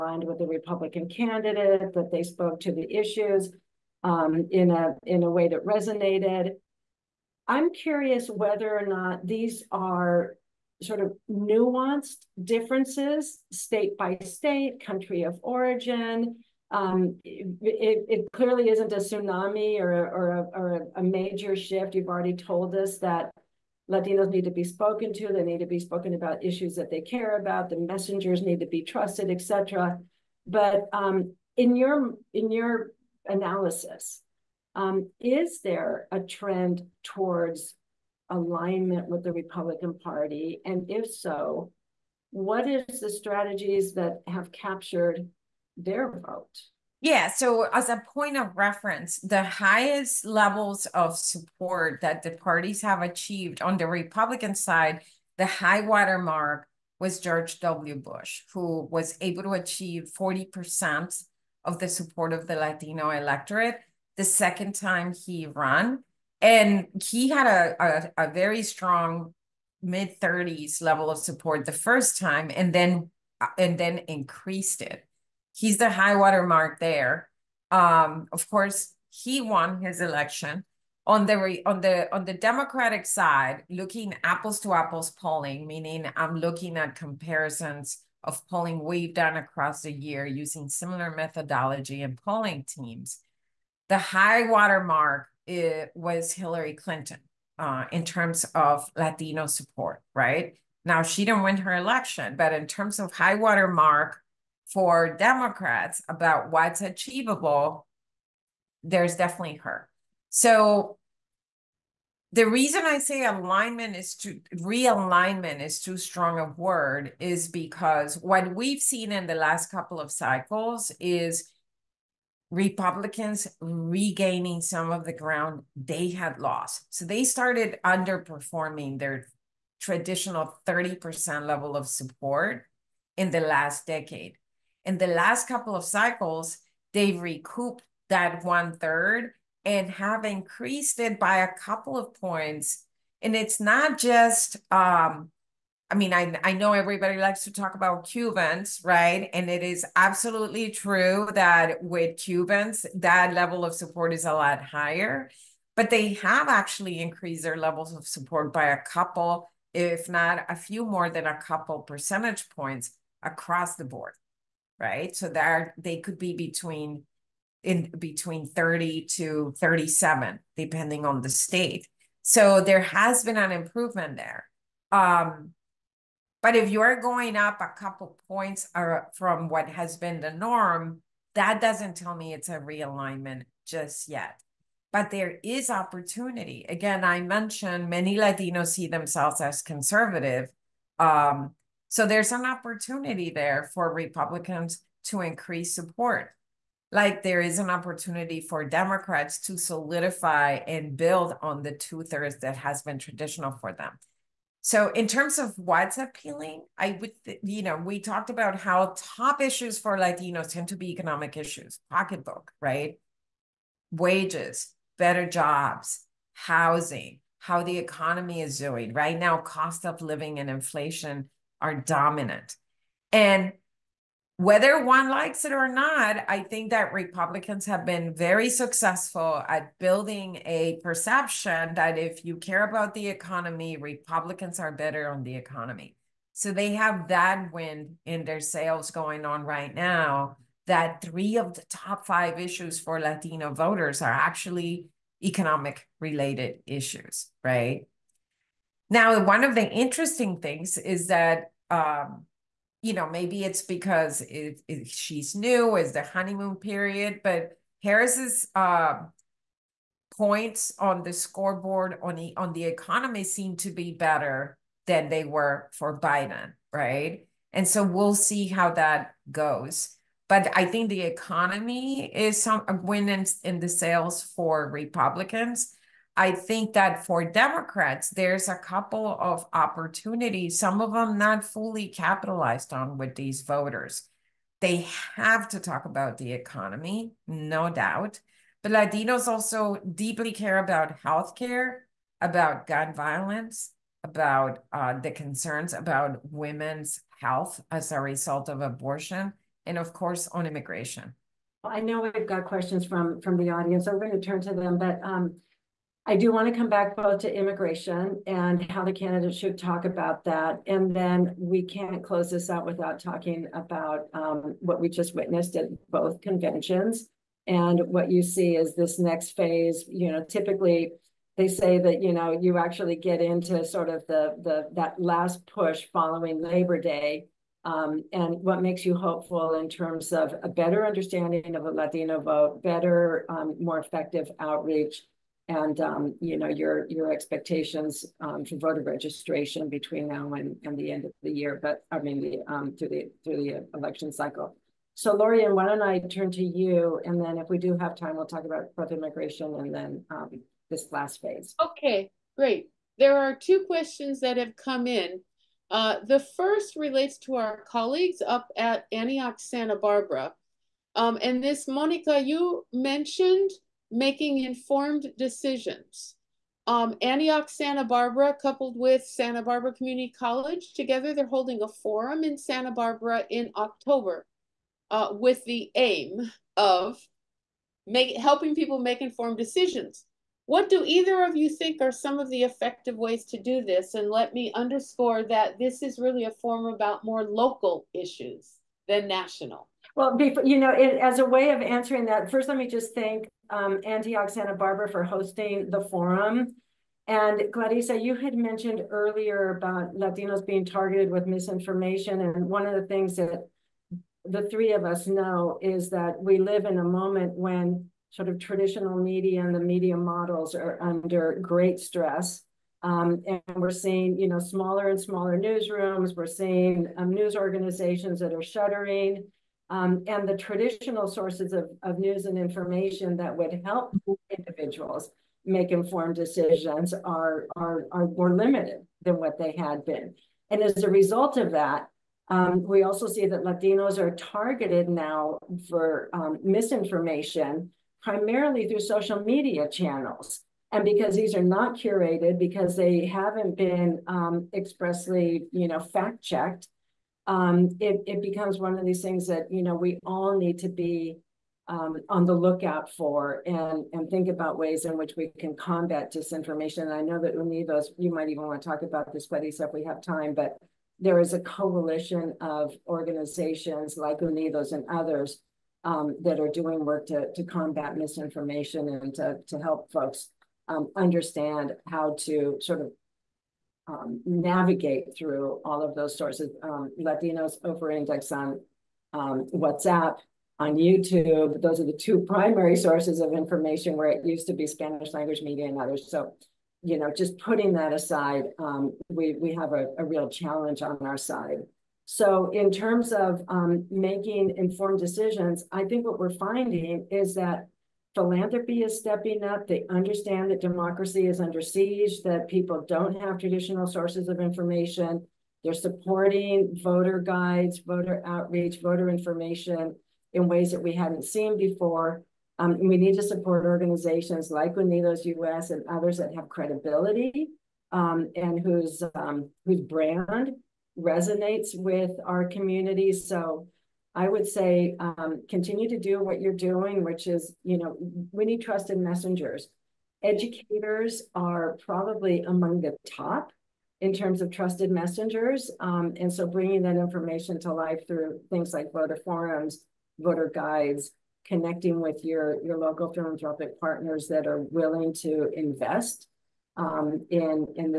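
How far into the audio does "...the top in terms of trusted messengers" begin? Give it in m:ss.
8:52.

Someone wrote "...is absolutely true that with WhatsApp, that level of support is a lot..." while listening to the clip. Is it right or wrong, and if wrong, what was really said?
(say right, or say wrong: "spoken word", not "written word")
wrong: "Cubans", not "WhatsApp".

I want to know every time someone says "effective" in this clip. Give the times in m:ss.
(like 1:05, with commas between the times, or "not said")
5:33, 6:22.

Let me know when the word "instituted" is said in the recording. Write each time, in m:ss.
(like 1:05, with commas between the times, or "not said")
not said.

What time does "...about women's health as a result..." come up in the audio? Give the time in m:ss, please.
4:55.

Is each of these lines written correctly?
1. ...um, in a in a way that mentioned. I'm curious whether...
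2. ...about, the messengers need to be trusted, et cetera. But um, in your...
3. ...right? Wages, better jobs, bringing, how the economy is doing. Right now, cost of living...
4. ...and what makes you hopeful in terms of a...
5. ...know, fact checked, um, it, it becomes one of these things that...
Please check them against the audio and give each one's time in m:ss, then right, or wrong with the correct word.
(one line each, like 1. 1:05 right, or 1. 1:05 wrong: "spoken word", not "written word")
1. 0:04 wrong: "resonated", not "mentioned"
2. 0:27 right
3. 3:32 wrong: "housing", not "bringing"
4. 5:28 right
5. 7:25 right.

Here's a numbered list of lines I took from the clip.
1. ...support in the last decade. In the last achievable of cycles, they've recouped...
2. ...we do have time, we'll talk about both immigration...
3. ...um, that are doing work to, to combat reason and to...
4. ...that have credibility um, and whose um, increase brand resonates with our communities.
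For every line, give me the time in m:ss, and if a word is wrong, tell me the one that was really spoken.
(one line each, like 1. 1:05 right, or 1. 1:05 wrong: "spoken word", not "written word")
1. 2:11 wrong: "couple", not "achievable"
2. 5:47 right
3. 7:45 wrong: "misinformation", not "reason"
4. 8:36 wrong: "whose", not "increase".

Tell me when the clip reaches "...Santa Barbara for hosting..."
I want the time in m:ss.
6:34.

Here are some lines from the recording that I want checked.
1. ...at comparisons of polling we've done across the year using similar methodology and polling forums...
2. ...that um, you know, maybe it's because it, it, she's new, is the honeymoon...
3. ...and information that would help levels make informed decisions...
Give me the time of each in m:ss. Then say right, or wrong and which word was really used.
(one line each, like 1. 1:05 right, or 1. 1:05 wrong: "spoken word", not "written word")
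1. 1:26 wrong: "teams", not "forums"
2. 4:11 right
3. 7:02 wrong: "individuals", not "levels".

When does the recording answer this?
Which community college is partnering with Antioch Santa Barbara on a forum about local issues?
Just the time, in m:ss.
6:09.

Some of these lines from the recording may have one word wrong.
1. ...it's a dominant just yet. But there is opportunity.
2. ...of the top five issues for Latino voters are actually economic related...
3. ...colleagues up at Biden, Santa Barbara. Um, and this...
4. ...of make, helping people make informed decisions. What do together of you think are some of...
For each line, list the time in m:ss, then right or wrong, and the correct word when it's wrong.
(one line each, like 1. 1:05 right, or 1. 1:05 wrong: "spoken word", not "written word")
1. 3:02 wrong: "realignment", not "dominant"
2. 4:01 right
3. 5:57 wrong: "Antioch", not "Biden"
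4. 6:16 wrong: "either", not "together".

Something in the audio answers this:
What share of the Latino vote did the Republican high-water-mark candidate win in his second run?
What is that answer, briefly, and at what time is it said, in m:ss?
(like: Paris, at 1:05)
40%, at 1:00.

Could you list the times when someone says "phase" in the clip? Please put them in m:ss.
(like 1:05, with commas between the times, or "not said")
5:19, 5:51.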